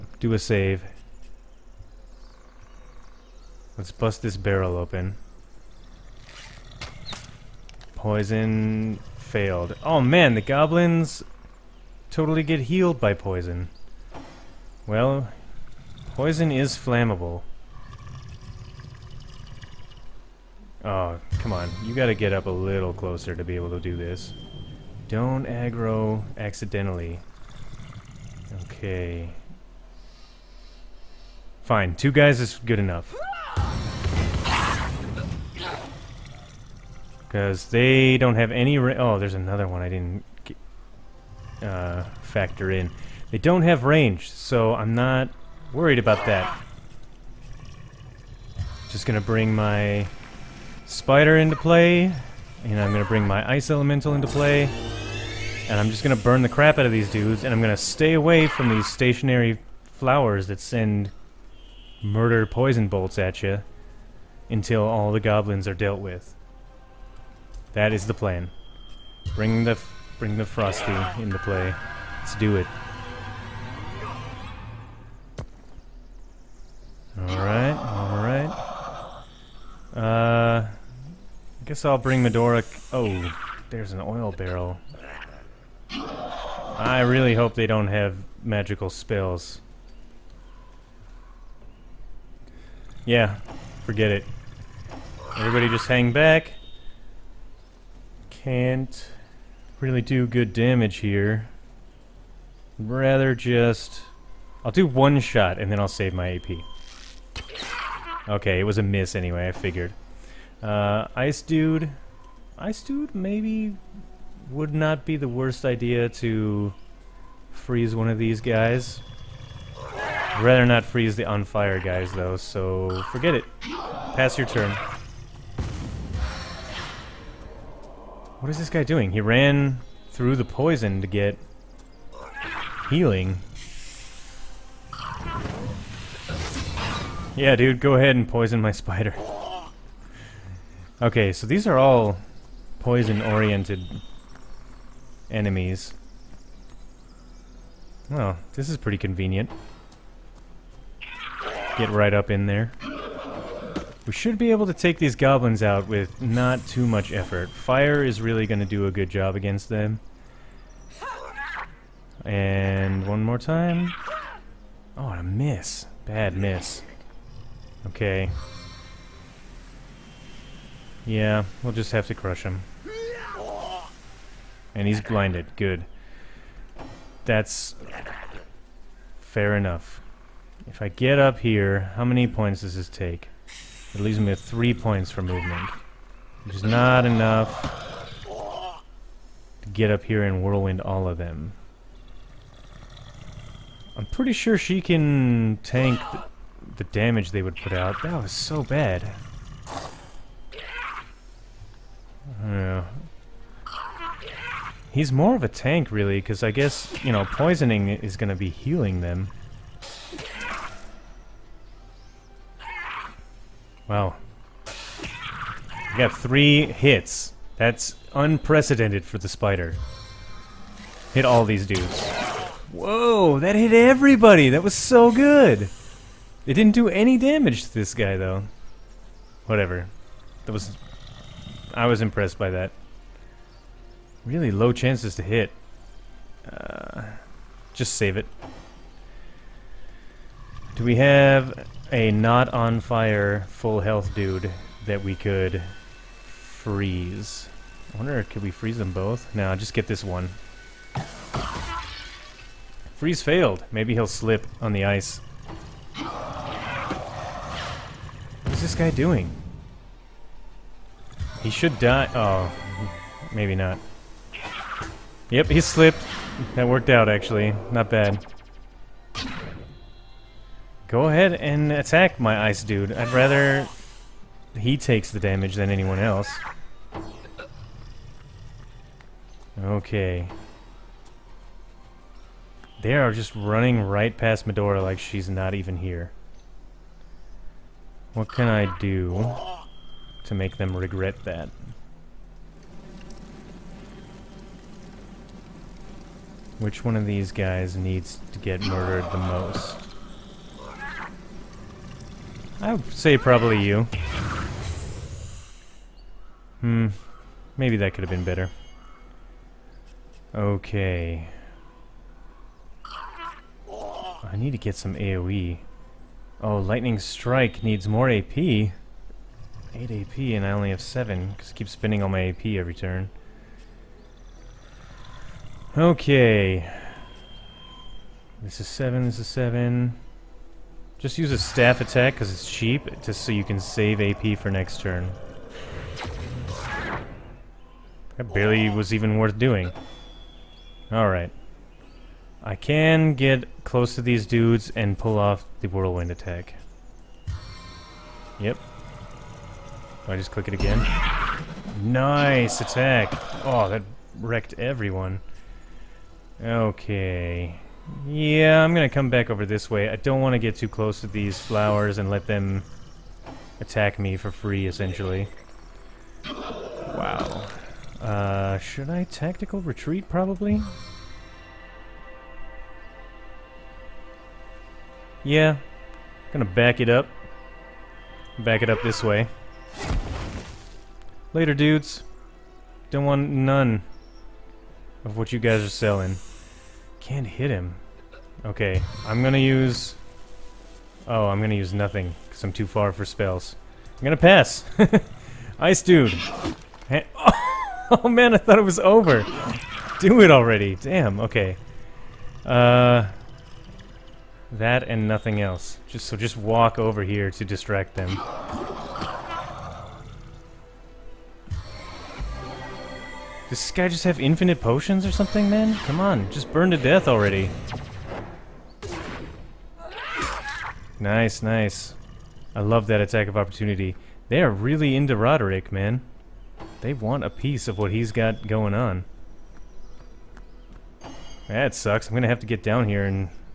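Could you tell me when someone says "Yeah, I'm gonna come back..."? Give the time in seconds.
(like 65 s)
358 s.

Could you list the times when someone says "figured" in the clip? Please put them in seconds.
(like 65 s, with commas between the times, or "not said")
109 s.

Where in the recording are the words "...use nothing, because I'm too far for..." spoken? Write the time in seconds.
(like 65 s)
391 s.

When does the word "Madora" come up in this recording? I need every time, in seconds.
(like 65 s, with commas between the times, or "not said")
82 s, 284 s.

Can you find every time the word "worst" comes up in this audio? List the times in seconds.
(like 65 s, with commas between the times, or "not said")
115 s.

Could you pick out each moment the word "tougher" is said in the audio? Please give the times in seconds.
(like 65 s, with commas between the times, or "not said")
not said.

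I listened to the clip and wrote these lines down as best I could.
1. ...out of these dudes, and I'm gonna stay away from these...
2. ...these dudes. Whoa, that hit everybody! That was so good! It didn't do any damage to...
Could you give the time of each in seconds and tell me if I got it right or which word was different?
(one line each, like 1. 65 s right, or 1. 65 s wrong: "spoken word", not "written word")
1. 56 s right
2. 221 s right.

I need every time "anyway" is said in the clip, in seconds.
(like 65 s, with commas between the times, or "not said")
109 s.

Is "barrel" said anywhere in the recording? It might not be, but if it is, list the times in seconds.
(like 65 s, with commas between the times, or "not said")
4 s, 84 s.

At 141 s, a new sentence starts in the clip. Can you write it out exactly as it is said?
Okay, so these are all poison-oriented enemies.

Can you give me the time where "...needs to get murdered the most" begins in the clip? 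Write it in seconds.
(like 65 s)
297 s.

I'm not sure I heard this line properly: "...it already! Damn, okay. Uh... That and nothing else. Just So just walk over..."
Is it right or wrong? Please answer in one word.
right.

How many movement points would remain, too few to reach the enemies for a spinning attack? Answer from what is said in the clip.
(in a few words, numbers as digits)
3.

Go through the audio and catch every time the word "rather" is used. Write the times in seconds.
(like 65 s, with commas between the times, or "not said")
102 s, 120 s, 273 s.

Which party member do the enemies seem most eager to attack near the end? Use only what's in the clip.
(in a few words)
Roderick.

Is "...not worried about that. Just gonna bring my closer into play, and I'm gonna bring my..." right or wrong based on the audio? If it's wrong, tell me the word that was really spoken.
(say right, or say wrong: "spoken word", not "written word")
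wrong: "spider", not "closer".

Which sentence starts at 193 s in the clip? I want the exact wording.
I'm pretty sure she can tank the, the damage they would put out.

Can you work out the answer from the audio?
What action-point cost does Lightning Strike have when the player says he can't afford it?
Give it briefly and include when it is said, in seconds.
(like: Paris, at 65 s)
8 AP, at 318 s.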